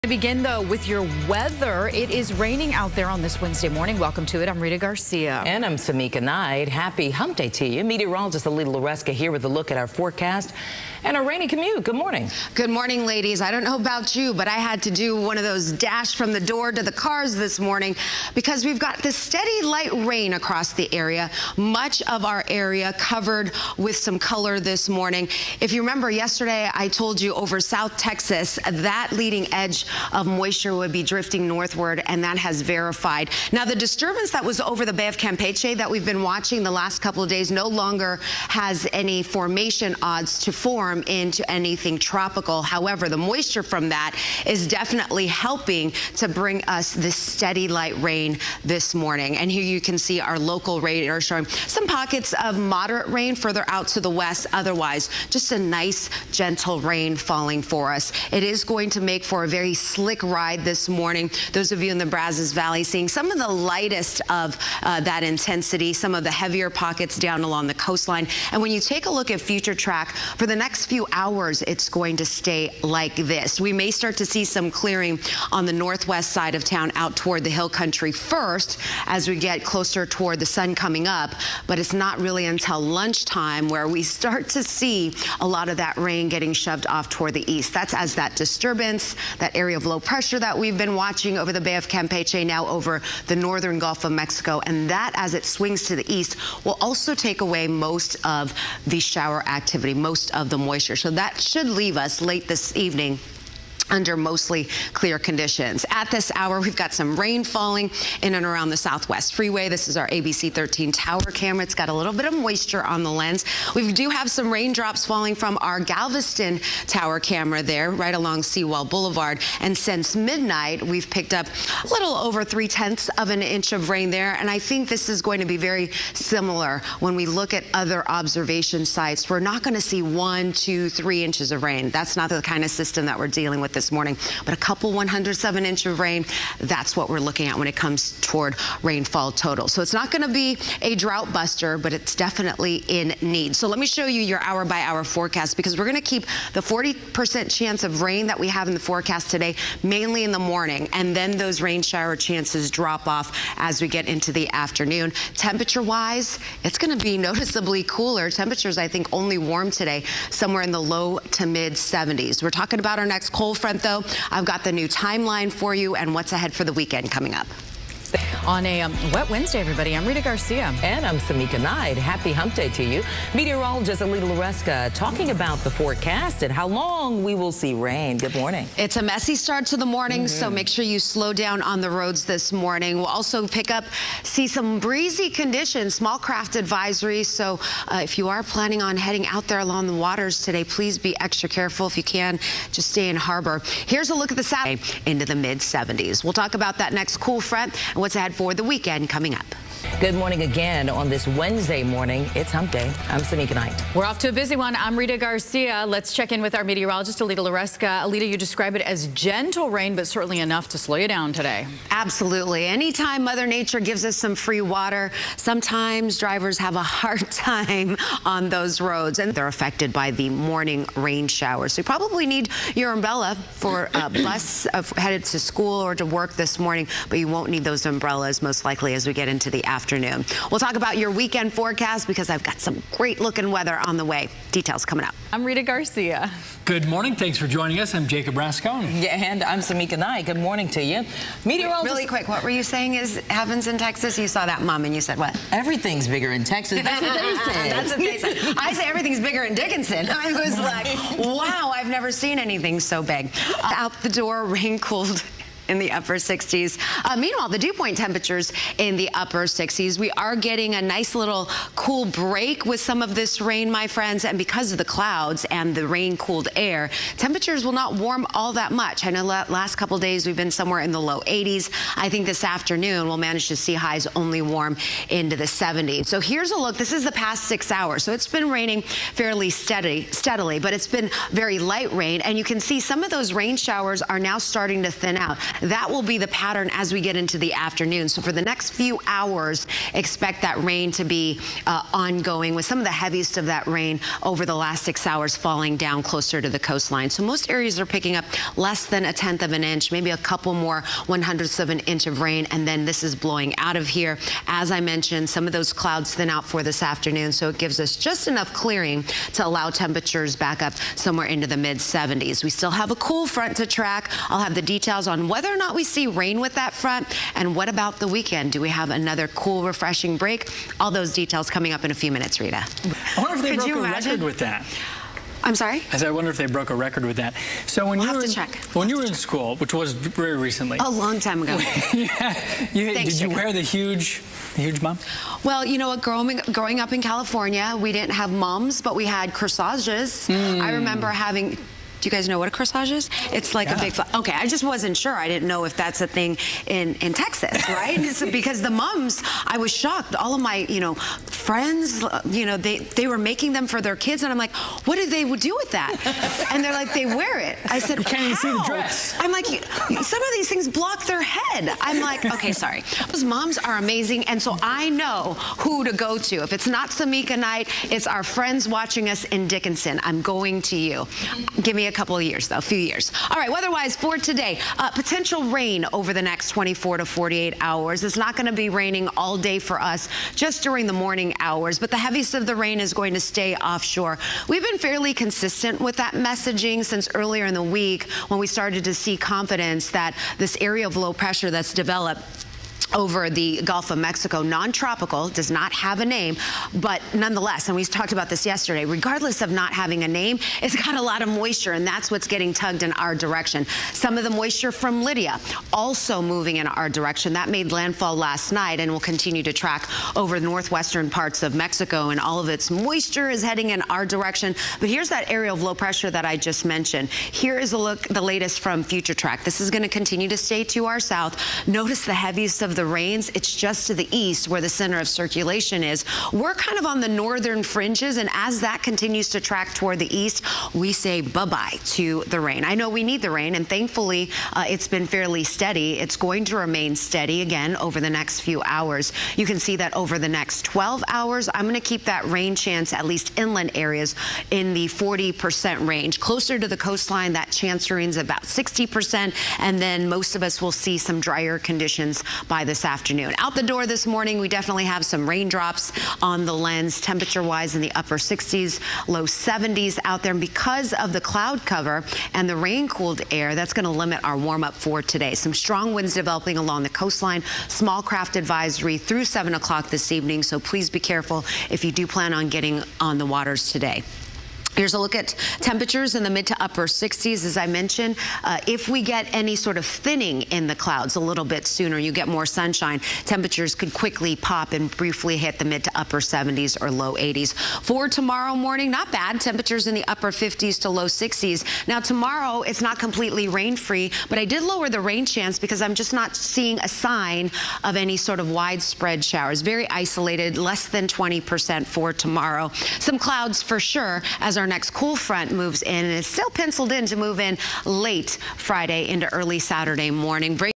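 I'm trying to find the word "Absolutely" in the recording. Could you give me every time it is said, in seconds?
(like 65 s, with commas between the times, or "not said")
211 s.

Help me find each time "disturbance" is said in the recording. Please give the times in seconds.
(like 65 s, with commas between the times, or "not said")
33 s, 88 s.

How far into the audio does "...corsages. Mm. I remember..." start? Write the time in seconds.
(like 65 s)
339 s.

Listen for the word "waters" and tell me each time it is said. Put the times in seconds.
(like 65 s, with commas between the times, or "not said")
189 s, 214 s, 473 s.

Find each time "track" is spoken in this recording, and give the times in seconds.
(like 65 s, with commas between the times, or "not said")
69 s, 313 s, 409 s, 419 s, 429 s.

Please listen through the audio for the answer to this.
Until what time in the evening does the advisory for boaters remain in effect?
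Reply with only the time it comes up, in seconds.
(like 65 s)
469 s.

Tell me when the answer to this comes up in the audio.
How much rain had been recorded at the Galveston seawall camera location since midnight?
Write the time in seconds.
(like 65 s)
121 s.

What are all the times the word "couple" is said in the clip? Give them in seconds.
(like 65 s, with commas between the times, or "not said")
37 s, 134 s, 269 s, 300 s, 371 s.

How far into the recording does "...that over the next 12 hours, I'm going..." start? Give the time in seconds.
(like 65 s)
439 s.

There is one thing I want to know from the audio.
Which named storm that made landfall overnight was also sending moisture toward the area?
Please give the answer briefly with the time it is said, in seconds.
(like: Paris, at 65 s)
Lidia, at 405 s.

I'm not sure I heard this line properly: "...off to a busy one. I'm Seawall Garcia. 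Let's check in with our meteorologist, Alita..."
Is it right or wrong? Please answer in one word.
wrong.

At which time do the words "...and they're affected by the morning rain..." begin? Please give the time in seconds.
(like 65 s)
219 s.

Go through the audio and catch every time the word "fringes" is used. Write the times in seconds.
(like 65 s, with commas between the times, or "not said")
427 s.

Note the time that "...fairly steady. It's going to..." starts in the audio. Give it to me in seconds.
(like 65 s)
435 s.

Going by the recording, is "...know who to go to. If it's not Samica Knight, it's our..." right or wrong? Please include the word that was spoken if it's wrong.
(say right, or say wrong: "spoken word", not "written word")
right.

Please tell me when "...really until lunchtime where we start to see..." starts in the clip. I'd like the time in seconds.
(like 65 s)
82 s.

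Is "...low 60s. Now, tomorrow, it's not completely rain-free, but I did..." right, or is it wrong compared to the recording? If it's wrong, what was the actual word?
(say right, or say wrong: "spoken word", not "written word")
right.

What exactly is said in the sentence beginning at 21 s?
Much of our area covered with some color this morning.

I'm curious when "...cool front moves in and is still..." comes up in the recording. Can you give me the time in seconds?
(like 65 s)
504 s.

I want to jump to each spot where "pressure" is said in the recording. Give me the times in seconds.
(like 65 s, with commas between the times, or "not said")
90 s, 391 s, 415 s.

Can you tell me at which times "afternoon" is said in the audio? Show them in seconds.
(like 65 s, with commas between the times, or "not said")
154 s, 229 s, 272 s, 287 s, 306 s, 452 s.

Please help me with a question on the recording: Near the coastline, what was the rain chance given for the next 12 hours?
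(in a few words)
60%.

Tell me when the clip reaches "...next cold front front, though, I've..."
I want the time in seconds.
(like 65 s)
163 s.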